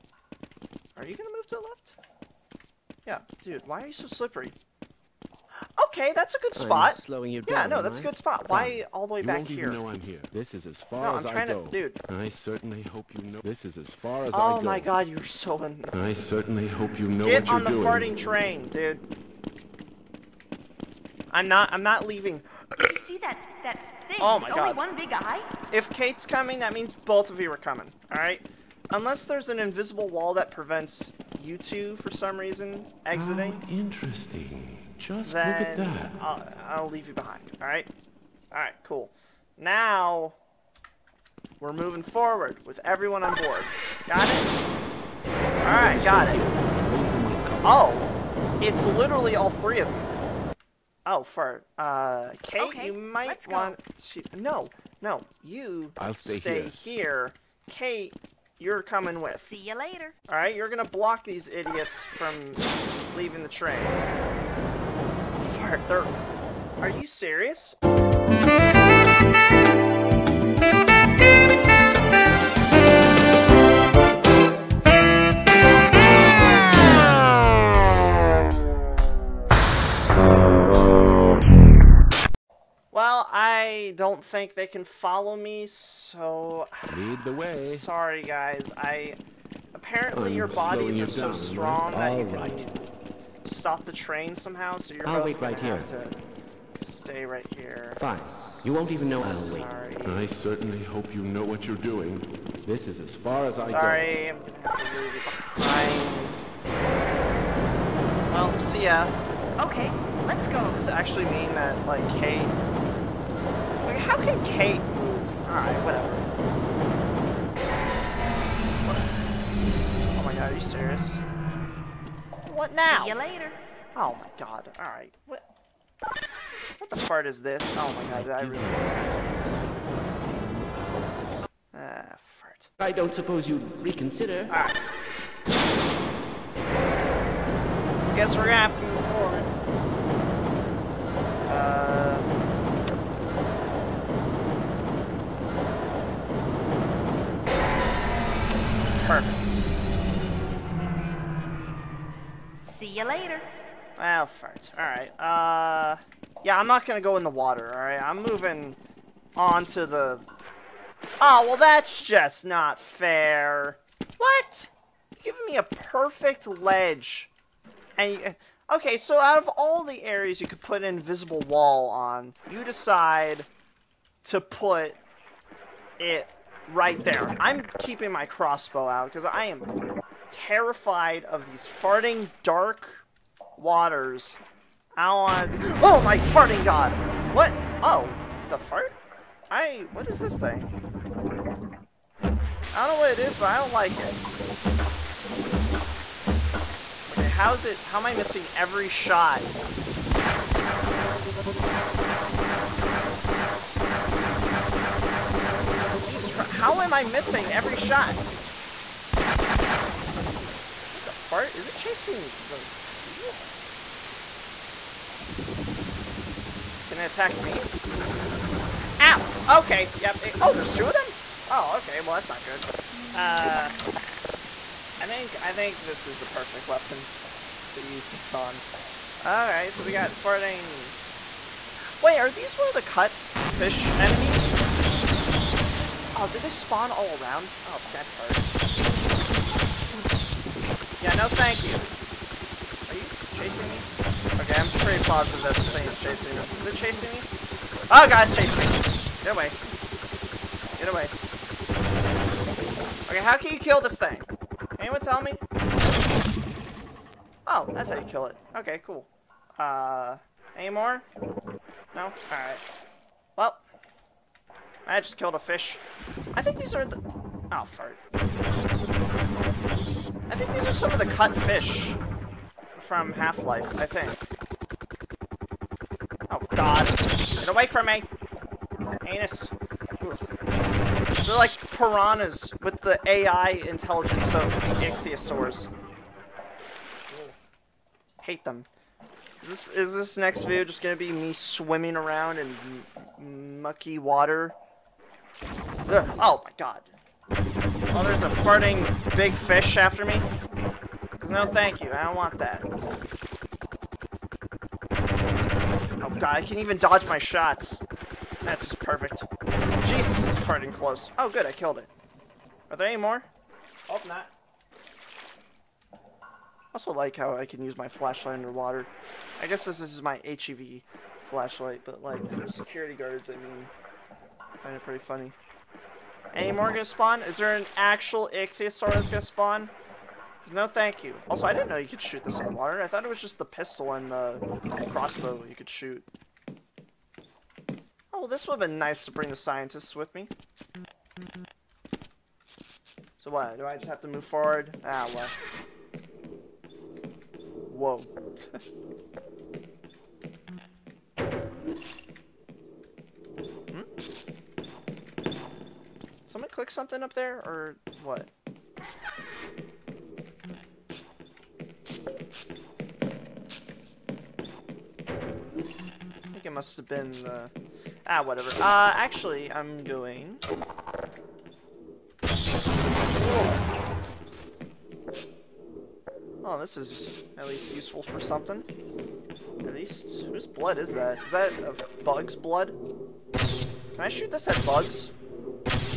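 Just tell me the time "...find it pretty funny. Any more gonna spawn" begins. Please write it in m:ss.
5:24.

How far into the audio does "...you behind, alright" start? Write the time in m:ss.
0:37.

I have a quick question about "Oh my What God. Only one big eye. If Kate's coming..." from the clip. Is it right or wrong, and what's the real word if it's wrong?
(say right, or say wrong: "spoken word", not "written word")
wrong: "Only", not "What".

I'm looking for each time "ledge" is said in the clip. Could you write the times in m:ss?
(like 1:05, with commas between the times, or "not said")
2:46.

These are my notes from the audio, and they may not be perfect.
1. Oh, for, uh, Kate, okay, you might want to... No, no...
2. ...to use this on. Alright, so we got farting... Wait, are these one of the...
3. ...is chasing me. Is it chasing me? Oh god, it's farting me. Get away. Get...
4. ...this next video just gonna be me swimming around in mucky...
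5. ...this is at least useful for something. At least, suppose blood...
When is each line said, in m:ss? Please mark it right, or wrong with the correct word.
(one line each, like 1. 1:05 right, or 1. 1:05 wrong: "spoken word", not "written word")
1. 0:51 right
2. 3:47 right
3. 4:05 wrong: "chasing", not "farting"
4. 4:49 right
5. 6:16 wrong: "whose", not "suppose".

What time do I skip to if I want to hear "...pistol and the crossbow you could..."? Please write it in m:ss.
5:33.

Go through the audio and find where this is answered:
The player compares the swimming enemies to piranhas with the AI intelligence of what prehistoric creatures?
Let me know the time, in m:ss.
4:44.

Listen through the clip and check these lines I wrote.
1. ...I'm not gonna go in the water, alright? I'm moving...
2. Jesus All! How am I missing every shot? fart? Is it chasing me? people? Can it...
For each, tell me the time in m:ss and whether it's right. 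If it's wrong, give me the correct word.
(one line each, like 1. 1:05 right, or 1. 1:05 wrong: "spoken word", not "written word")
1. 2:36 right
2. 3:26 wrong: "Christ", not "All".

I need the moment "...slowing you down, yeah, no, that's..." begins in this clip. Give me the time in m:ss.
0:07.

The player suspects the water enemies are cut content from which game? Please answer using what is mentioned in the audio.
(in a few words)
Half-Life.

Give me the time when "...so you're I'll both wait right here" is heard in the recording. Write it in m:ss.
1:34.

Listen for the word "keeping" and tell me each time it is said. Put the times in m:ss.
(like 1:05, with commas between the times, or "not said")
2:57.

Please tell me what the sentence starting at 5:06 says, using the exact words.
Oh god, I can even dodge my shots.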